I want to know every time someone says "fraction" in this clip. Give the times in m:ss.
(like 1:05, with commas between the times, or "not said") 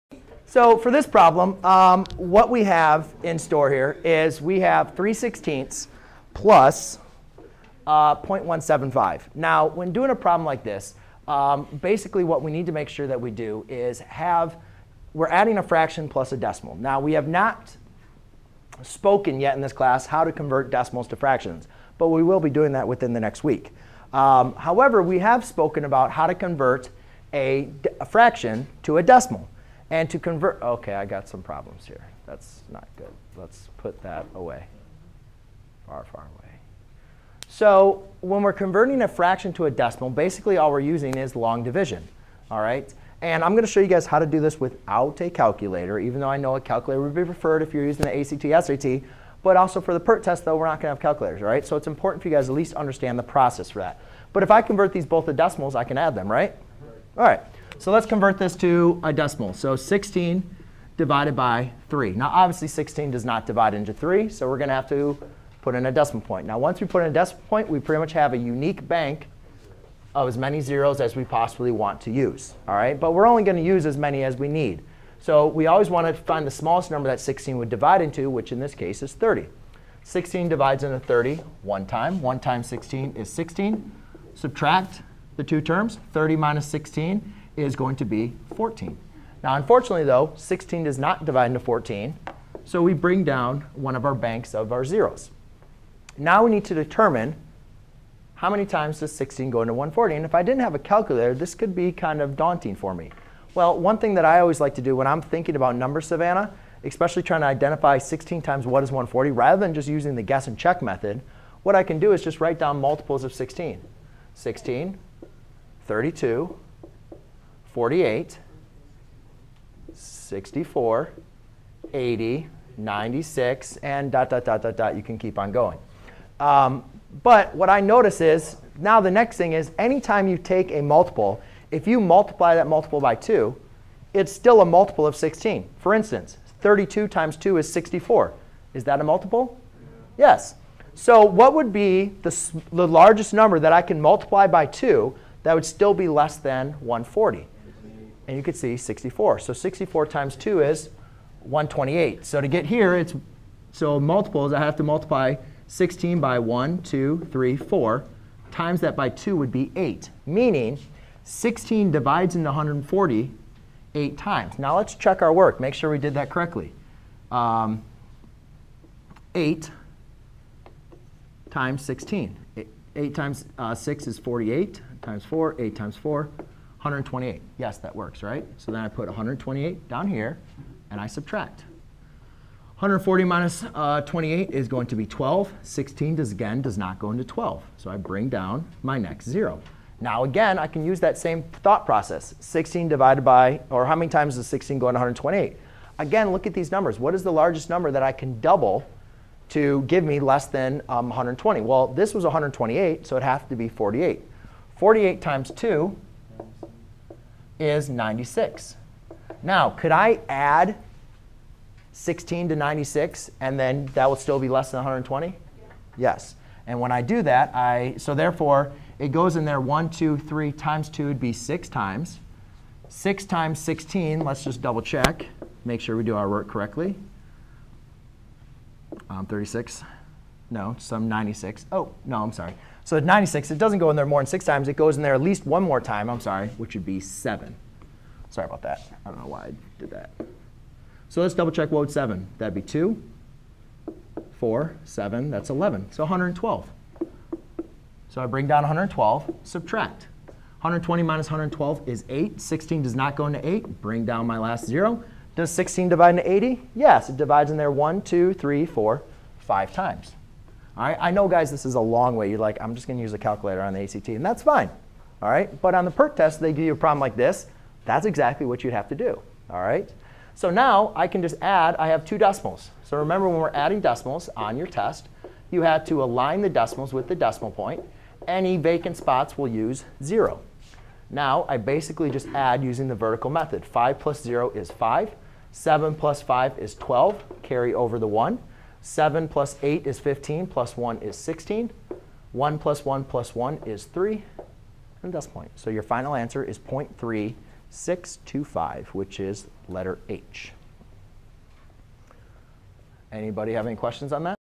0:15, 0:21, 0:28, 0:39.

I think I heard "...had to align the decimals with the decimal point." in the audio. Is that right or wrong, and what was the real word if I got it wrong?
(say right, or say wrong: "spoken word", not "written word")
right.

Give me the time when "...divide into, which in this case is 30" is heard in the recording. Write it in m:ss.
1:17.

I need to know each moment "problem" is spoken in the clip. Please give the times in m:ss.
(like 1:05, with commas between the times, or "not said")
0:01, 0:10, 0:31, 4:26.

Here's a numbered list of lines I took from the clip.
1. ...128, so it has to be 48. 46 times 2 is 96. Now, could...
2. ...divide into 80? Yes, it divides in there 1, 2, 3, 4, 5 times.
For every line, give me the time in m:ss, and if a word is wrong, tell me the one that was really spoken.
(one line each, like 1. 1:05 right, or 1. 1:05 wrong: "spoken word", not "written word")
1. 3:22 wrong: "48", not "46"
2. 4:15 right.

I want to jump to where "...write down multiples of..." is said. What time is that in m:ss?
1:52.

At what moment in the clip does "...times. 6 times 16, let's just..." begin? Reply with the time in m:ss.
3:41.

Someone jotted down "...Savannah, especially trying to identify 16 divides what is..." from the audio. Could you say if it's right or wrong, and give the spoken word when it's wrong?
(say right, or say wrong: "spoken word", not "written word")
wrong: "times", not "divides".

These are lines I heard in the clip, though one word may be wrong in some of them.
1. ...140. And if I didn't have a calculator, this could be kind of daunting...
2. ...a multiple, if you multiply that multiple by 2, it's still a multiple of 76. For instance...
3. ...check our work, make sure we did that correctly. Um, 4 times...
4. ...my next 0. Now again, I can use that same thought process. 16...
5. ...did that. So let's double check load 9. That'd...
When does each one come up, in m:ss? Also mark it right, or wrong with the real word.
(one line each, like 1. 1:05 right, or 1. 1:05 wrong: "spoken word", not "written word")
1. 1:39 right
2. 2:10 wrong: "16", not "76"
3. 2:44 wrong: "8", not "4"
4. 3:08 right
5. 3:59 wrong: "7", not "9".